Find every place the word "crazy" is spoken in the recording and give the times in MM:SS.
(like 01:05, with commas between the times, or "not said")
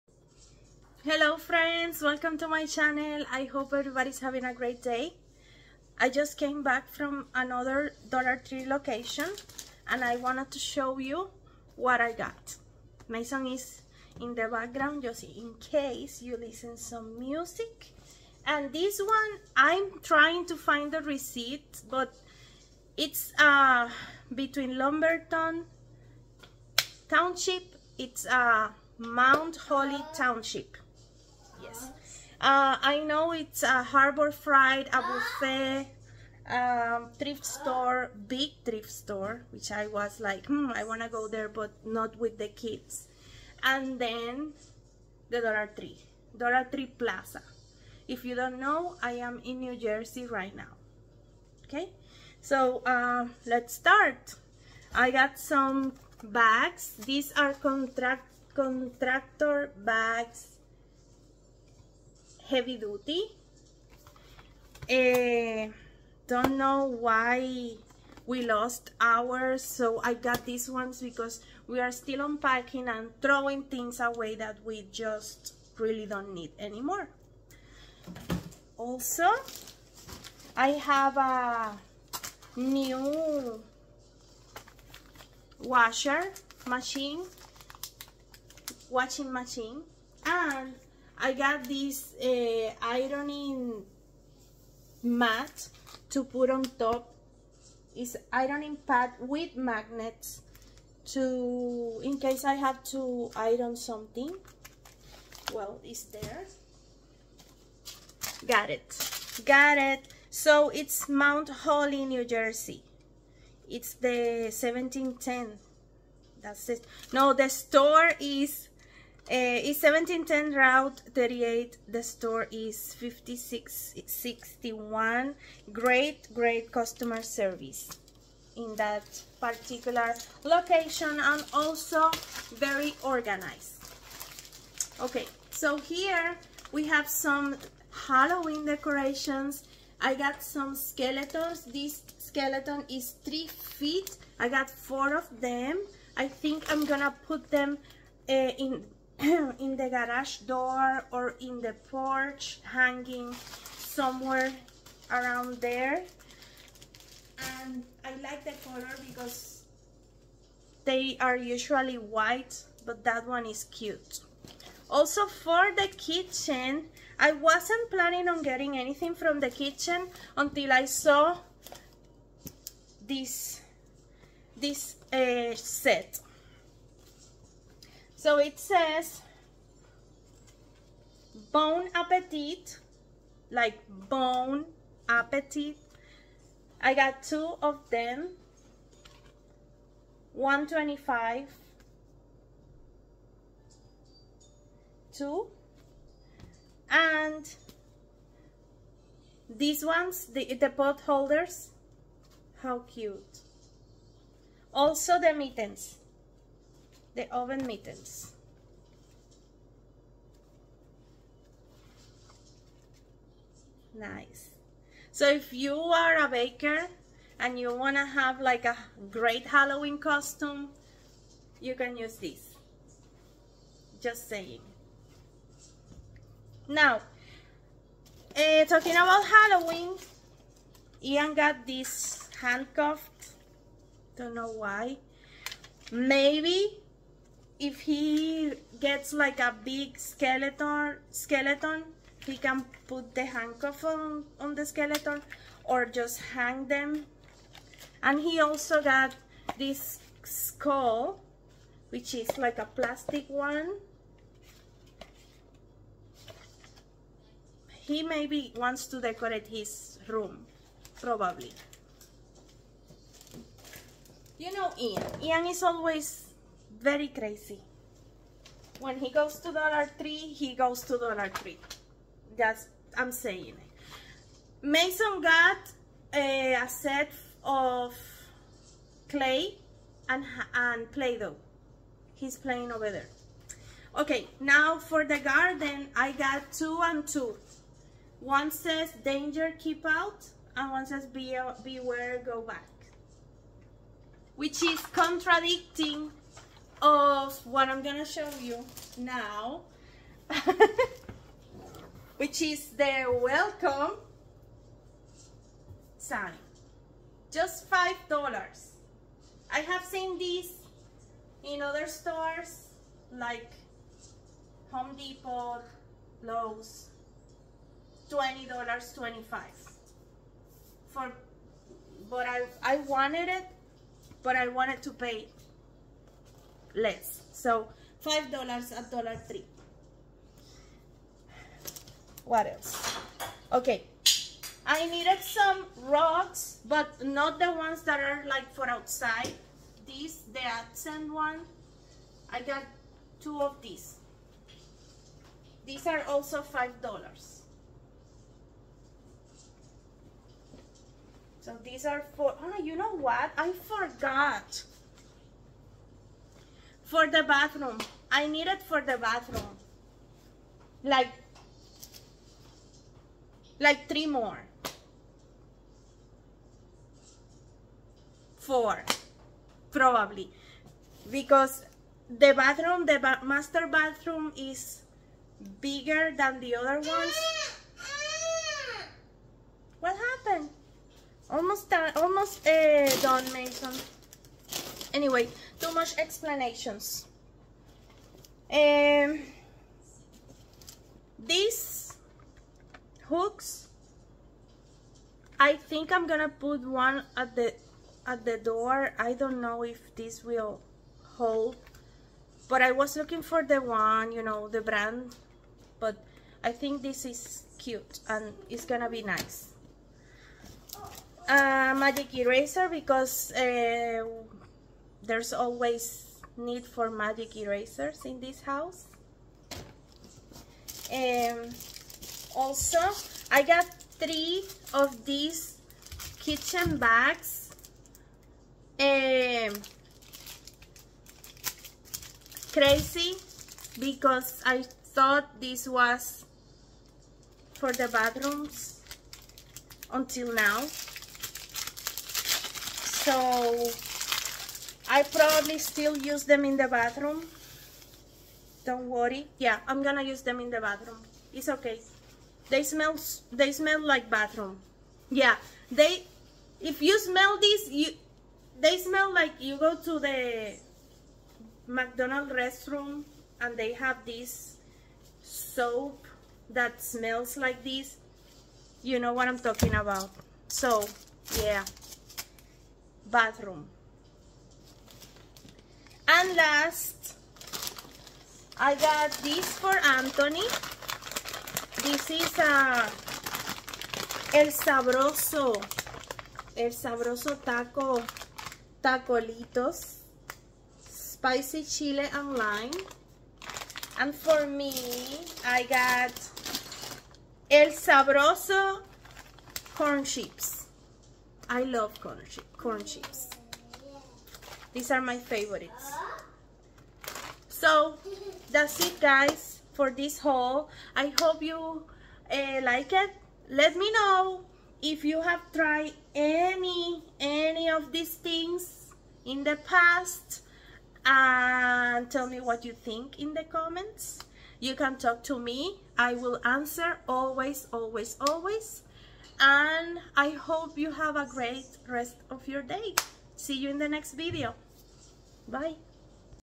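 04:27, 07:12.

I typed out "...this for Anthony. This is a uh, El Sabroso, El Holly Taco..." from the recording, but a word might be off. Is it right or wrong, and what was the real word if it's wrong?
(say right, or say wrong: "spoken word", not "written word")
wrong: "Sabroso", not "Holly".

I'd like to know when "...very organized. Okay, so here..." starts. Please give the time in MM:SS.
02:12.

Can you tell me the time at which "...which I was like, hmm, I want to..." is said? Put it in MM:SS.
00:39.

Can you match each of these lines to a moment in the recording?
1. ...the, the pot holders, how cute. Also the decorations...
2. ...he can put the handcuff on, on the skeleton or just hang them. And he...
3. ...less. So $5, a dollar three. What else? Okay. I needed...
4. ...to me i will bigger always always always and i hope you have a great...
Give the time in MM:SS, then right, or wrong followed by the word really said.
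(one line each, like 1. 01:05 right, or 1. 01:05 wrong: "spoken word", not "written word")
1. 03:20 wrong: "mittens", not "decorations"
2. 04:02 right
3. 05:26 right
4. 08:45 wrong: "answer", not "bigger".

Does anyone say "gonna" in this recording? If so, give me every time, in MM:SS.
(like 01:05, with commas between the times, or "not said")
02:26, 04:57, 06:36, 06:48, 07:29.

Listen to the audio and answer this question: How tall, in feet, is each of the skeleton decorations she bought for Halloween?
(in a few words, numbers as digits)
3.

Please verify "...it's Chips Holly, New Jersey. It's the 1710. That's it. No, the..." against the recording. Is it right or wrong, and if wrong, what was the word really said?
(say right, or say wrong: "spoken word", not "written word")
wrong: "Mount", not "Chips".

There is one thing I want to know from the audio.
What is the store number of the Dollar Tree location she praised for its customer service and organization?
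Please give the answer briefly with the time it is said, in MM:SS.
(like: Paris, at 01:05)
5661, at 02:02.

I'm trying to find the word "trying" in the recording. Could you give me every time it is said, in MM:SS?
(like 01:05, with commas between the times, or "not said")
00:20.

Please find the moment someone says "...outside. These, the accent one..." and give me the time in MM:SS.
05:38.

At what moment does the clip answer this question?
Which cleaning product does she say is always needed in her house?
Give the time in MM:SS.
06:51.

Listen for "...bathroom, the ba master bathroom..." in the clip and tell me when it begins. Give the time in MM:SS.
06:12.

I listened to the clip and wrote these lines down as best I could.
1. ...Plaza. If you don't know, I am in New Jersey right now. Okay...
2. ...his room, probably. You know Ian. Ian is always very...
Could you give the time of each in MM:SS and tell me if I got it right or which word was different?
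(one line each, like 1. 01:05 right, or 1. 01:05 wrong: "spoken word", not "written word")
1. 00:46 right
2. 04:19 right.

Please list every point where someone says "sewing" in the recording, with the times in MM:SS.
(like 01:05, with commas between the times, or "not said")
not said.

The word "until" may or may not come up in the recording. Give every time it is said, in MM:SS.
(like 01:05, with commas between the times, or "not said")
02:50, 07:19.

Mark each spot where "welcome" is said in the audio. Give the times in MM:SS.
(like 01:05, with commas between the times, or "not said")
00:02, 05:03.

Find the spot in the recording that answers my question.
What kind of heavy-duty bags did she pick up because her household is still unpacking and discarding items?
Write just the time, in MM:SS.
00:58.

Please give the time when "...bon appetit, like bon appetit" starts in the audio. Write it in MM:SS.
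03:01.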